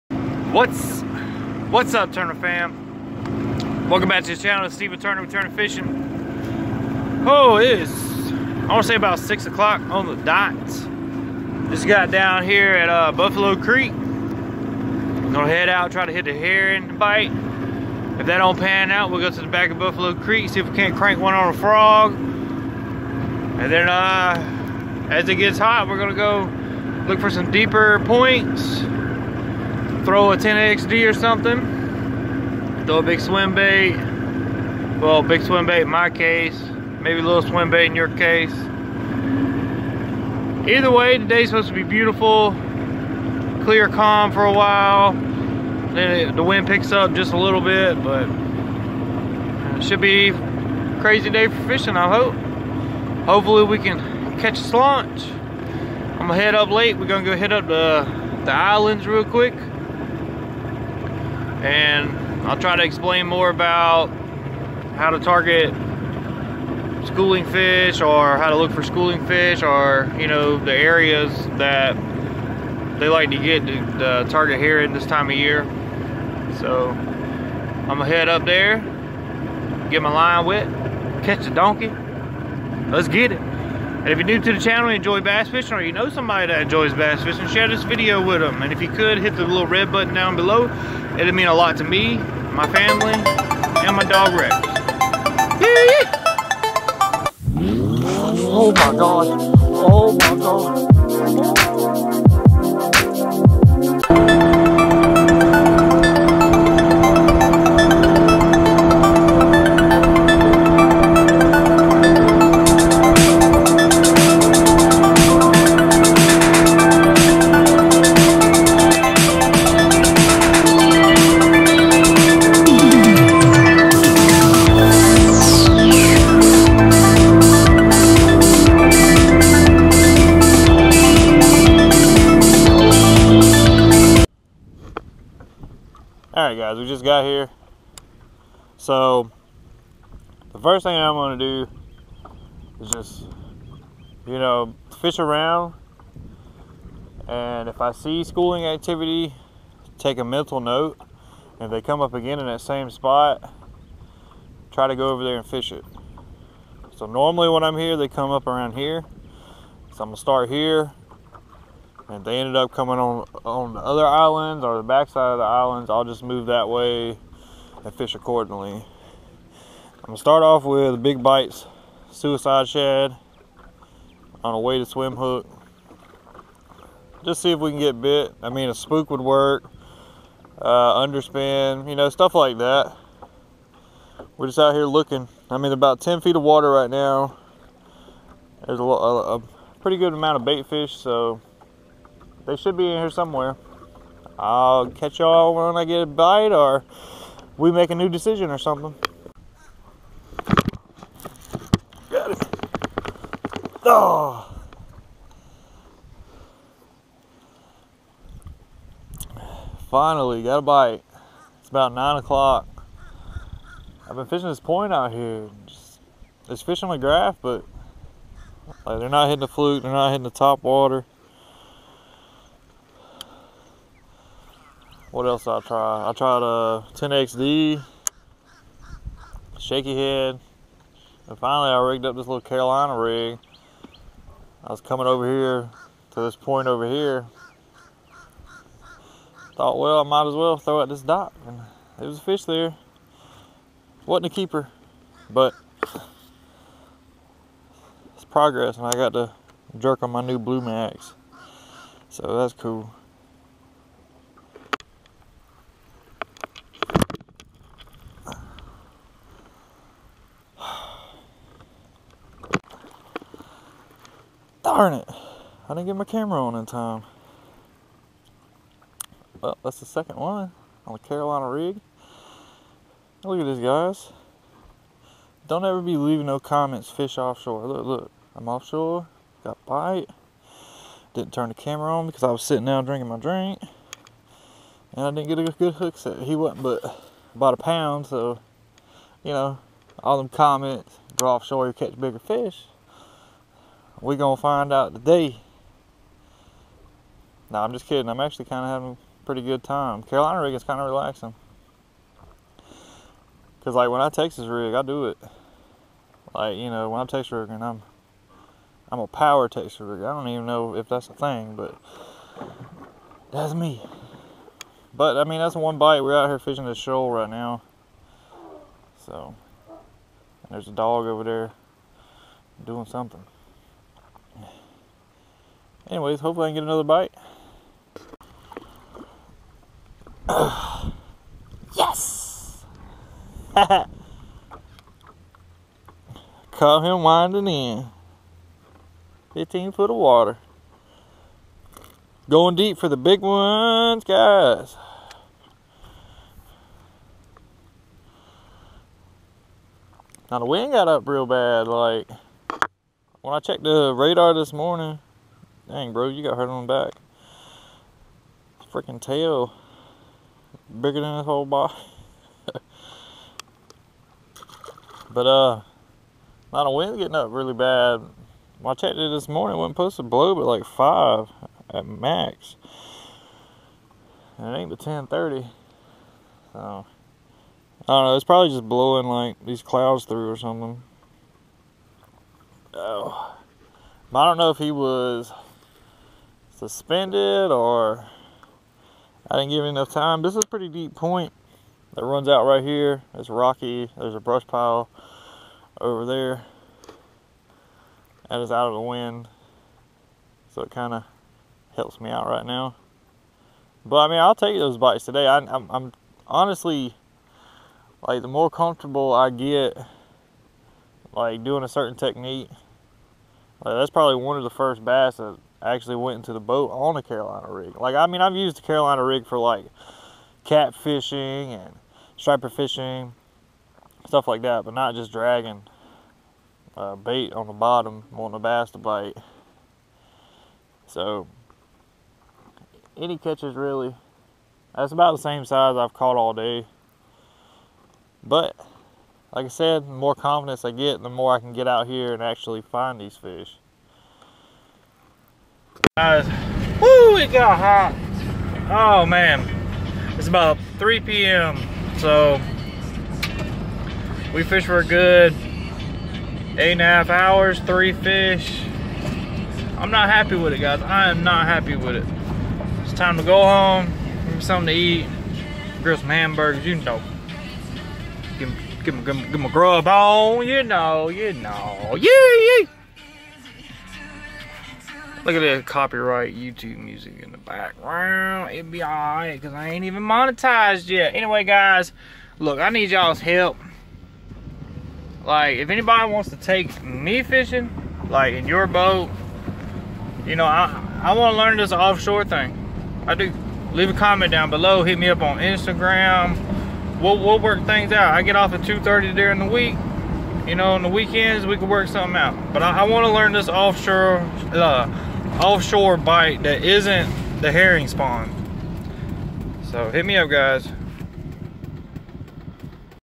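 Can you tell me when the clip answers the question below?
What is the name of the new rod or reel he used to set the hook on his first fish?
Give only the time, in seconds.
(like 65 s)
250 s.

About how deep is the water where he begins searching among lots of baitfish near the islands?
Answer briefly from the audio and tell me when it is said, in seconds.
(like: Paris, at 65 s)
10 feet, at 186 s.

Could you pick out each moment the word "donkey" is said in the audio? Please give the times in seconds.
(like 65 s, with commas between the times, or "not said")
81 s.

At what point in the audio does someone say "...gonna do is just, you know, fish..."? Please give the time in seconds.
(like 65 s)
141 s.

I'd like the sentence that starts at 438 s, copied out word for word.
But, like I said, the more confidence I get, the more I can get out here and actually find these fish guys.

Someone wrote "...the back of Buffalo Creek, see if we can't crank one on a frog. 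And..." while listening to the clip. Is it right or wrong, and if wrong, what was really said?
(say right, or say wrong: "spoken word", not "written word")
right.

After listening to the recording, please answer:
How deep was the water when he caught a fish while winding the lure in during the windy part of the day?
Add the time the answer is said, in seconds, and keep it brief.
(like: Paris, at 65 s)
15 feet, at 339 s.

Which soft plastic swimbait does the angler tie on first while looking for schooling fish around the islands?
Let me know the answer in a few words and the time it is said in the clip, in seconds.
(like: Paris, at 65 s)
suicide shad, at 172 s.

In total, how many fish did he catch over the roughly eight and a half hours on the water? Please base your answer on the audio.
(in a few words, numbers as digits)
3.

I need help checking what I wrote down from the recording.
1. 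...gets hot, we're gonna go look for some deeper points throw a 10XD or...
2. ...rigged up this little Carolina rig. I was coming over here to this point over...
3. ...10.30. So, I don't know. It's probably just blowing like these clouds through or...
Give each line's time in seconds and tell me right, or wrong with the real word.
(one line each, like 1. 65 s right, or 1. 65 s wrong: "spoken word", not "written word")
1. 25 s right
2. 231 s right
3. 374 s right.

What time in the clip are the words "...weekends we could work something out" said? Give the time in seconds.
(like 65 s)
500 s.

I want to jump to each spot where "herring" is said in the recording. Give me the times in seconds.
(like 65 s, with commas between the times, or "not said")
16 s, 507 s.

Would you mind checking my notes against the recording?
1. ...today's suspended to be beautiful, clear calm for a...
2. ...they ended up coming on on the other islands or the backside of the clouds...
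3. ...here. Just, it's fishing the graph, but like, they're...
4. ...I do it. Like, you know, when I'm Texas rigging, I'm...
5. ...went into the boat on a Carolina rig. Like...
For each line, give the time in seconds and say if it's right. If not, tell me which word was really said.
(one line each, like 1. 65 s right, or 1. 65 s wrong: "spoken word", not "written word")
1. 41 s wrong: "supposed", not "suspended"
2. 162 s wrong: "islands", not "clouds"
3. 215 s right
4. 304 s right
5. 415 s right.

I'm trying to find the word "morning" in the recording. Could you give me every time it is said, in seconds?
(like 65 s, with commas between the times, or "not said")
354 s, 369 s.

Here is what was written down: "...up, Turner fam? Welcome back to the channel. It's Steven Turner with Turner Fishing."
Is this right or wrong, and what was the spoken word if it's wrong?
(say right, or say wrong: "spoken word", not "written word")
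right.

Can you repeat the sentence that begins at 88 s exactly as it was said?
And if you could, hit the little red button down below.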